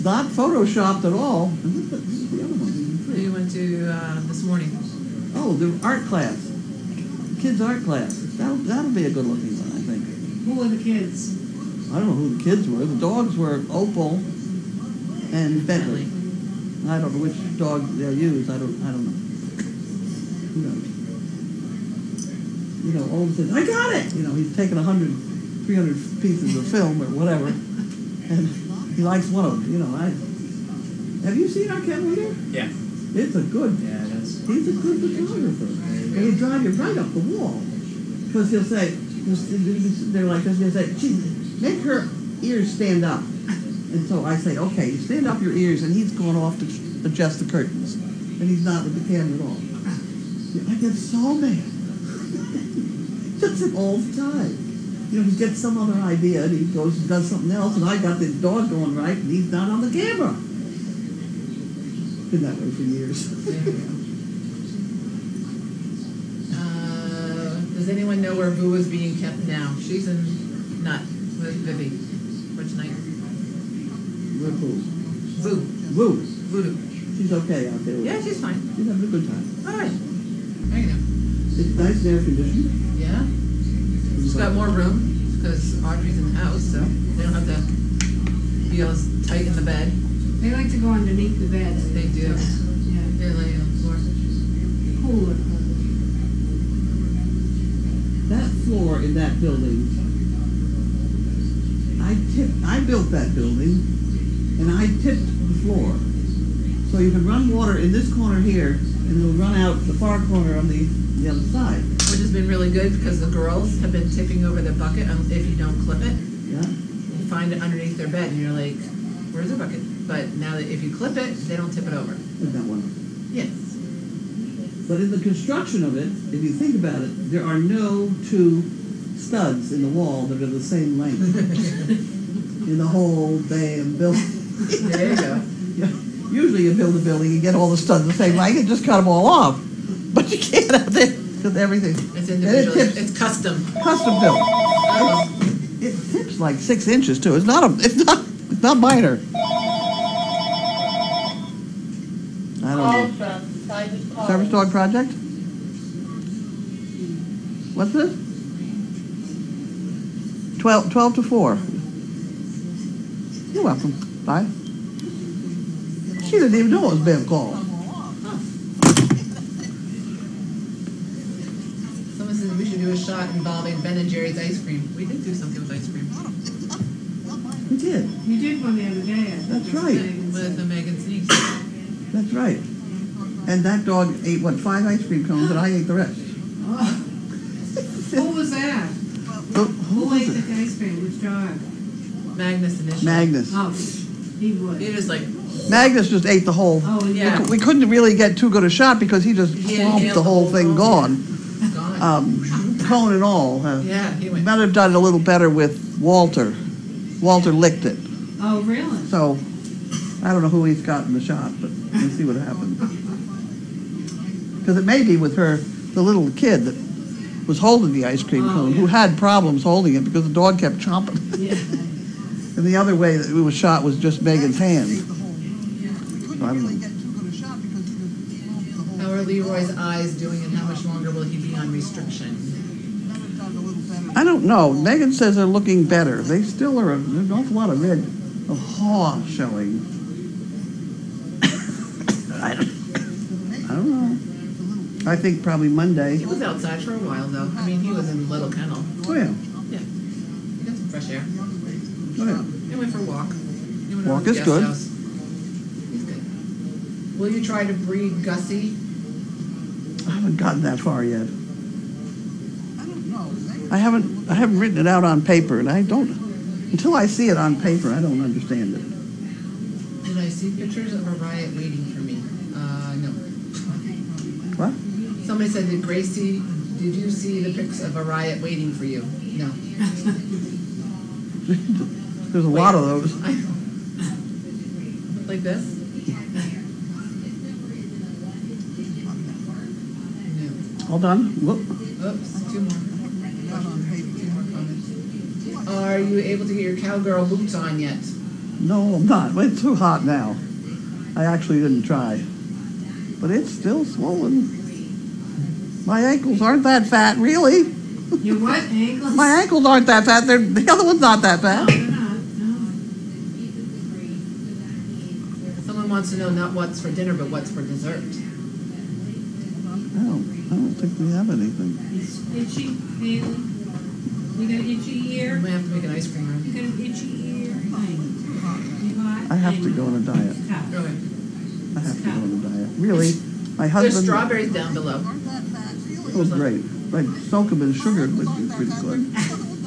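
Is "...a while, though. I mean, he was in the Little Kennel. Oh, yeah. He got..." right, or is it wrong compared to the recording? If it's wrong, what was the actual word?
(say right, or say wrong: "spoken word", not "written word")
right.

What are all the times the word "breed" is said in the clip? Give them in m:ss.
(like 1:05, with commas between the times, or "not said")
4:17.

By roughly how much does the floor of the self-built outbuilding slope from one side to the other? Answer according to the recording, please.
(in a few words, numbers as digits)
6 inches.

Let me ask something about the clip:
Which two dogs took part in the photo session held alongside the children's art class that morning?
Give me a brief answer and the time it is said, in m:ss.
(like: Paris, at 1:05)
Opal and Bentley, at 0:13.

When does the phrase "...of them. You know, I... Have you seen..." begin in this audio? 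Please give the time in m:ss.
0:29.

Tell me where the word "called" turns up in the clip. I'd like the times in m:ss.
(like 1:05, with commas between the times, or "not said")
2:47.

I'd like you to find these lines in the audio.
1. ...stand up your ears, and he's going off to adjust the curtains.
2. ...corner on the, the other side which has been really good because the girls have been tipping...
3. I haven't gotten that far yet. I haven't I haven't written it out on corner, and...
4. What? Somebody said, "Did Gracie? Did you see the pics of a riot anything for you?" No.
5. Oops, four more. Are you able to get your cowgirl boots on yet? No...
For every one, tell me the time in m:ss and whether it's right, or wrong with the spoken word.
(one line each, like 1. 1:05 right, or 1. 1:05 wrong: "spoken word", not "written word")
1. 0:44 right
2. 1:50 right
3. 4:20 wrong: "paper", not "corner"
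4. 4:34 wrong: "waiting", not "anything"
5. 4:52 wrong: "two", not "four".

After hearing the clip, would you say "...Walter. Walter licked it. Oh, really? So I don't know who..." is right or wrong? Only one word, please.
right.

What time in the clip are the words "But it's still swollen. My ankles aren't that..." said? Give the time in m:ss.
5:03.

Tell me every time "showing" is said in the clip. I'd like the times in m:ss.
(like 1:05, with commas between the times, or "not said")
3:59.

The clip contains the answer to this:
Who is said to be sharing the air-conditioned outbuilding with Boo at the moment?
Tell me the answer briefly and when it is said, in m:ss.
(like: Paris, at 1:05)
Vivi, at 1:11.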